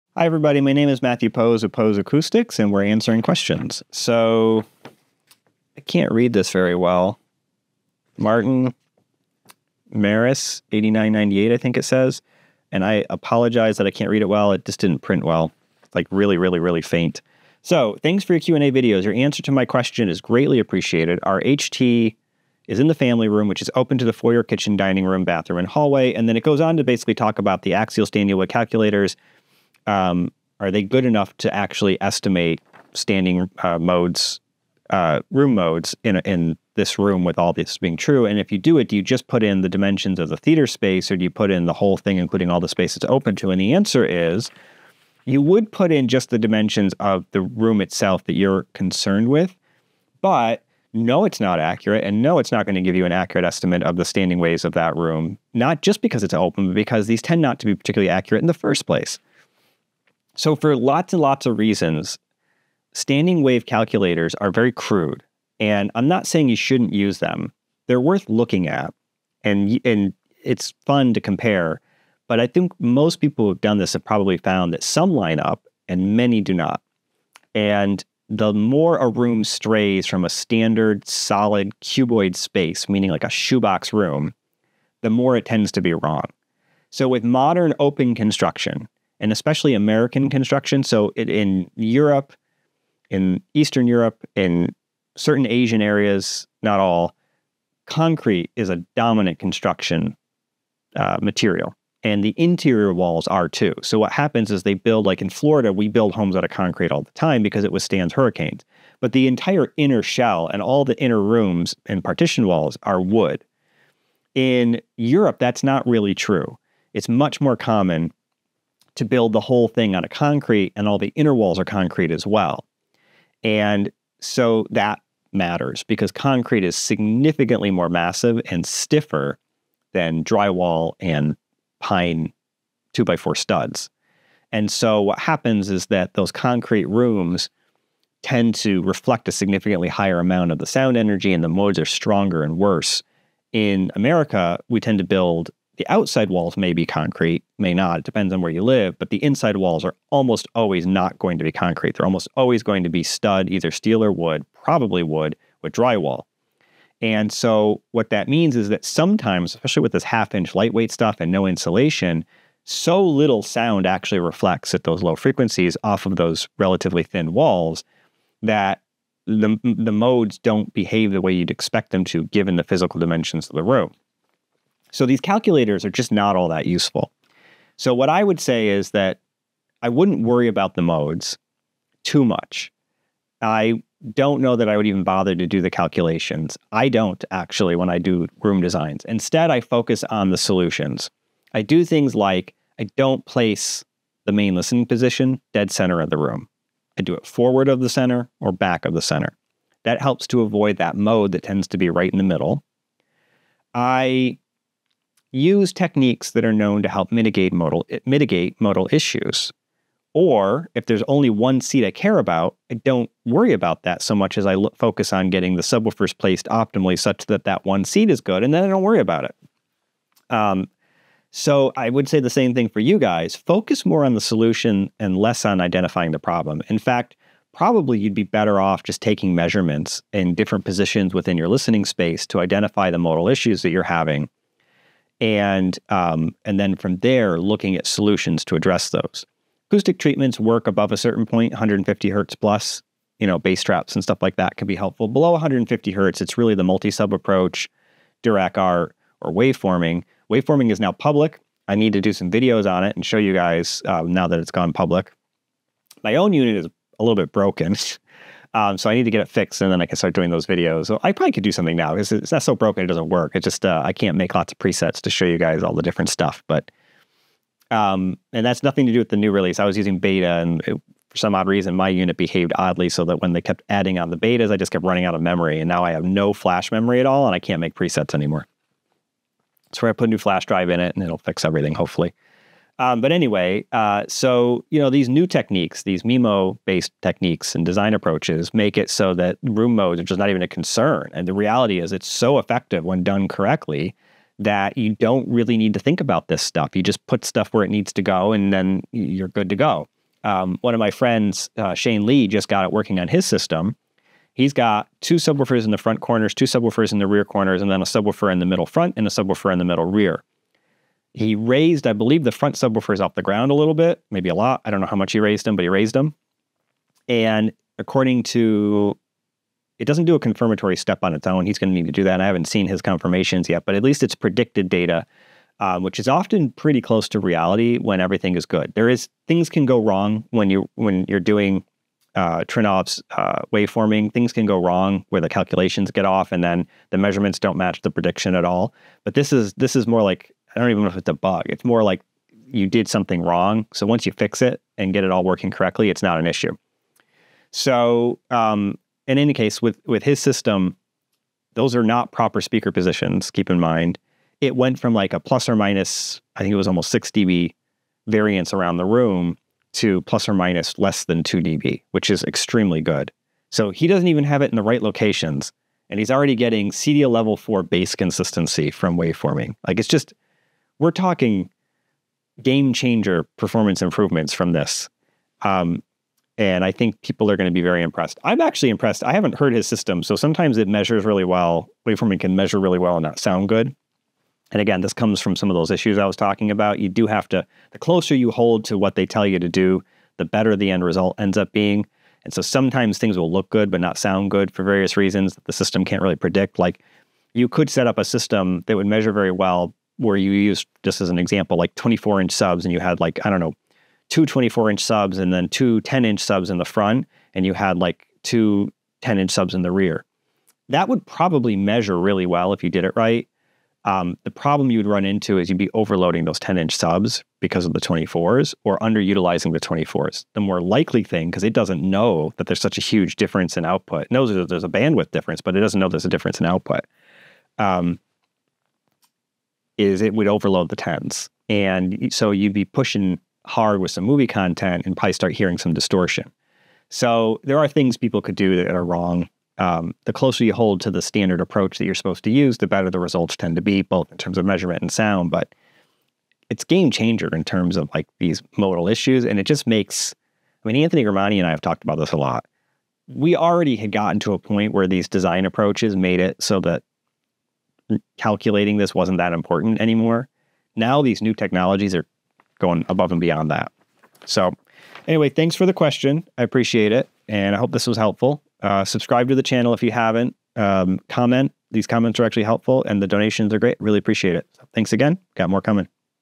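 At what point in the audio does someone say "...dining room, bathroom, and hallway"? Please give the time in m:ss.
0:24.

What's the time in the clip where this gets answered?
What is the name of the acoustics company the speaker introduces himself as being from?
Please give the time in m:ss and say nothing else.
0:01.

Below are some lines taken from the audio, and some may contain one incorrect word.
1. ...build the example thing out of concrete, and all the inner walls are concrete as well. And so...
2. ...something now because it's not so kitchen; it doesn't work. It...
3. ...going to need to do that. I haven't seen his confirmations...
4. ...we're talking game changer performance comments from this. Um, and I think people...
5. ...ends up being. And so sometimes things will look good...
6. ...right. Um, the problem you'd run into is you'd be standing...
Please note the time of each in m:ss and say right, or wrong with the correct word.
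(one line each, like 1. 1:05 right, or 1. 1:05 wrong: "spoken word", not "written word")
1. 1:59 wrong: "whole", not "example"
2. 4:21 wrong: "broken", not "kitchen"
3. 5:21 right
4. 6:10 wrong: "improvements", not "comments"
5. 6:31 right
6. 6:52 wrong: "overloading", not "standing".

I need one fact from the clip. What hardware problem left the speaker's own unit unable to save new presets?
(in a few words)
no flash memory.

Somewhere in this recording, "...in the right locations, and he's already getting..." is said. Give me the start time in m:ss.
6:04.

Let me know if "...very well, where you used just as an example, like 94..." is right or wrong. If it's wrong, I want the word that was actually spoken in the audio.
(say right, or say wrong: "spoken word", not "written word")
wrong: "24", not "94".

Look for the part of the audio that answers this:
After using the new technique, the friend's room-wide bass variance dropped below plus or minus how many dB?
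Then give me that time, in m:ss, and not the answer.
6:01.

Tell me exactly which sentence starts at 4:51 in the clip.
And the reality is, it's so effective when done correctly that you don't really need to think about this stuff.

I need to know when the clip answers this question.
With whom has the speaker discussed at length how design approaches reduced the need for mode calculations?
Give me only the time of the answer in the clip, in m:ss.
7:30.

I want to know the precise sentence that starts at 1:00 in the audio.
So, for lots and lots of reasons, standing wave calculators are very crude.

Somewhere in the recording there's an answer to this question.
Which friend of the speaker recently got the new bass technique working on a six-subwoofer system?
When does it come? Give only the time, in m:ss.
5:01.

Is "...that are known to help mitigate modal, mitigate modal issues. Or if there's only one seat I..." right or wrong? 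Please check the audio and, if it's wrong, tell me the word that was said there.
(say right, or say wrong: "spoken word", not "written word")
right.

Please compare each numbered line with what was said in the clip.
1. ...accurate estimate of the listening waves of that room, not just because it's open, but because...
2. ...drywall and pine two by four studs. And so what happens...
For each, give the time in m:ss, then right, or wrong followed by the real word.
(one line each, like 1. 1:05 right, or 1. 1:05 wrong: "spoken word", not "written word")
1. 0:53 wrong: "standing", not "listening"
2. 2:10 right.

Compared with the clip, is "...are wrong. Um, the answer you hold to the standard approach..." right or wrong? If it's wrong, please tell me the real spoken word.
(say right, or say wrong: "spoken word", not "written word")
wrong: "closer", not "answer".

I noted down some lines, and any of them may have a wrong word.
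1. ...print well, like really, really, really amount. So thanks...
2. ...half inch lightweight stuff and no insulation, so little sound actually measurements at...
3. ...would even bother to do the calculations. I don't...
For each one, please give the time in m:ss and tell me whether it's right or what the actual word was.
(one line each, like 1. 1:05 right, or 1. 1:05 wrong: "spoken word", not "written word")
1. 0:14 wrong: "faint", not "amount"
2. 2:40 wrong: "reflects", not "measurements"
3. 3:04 right.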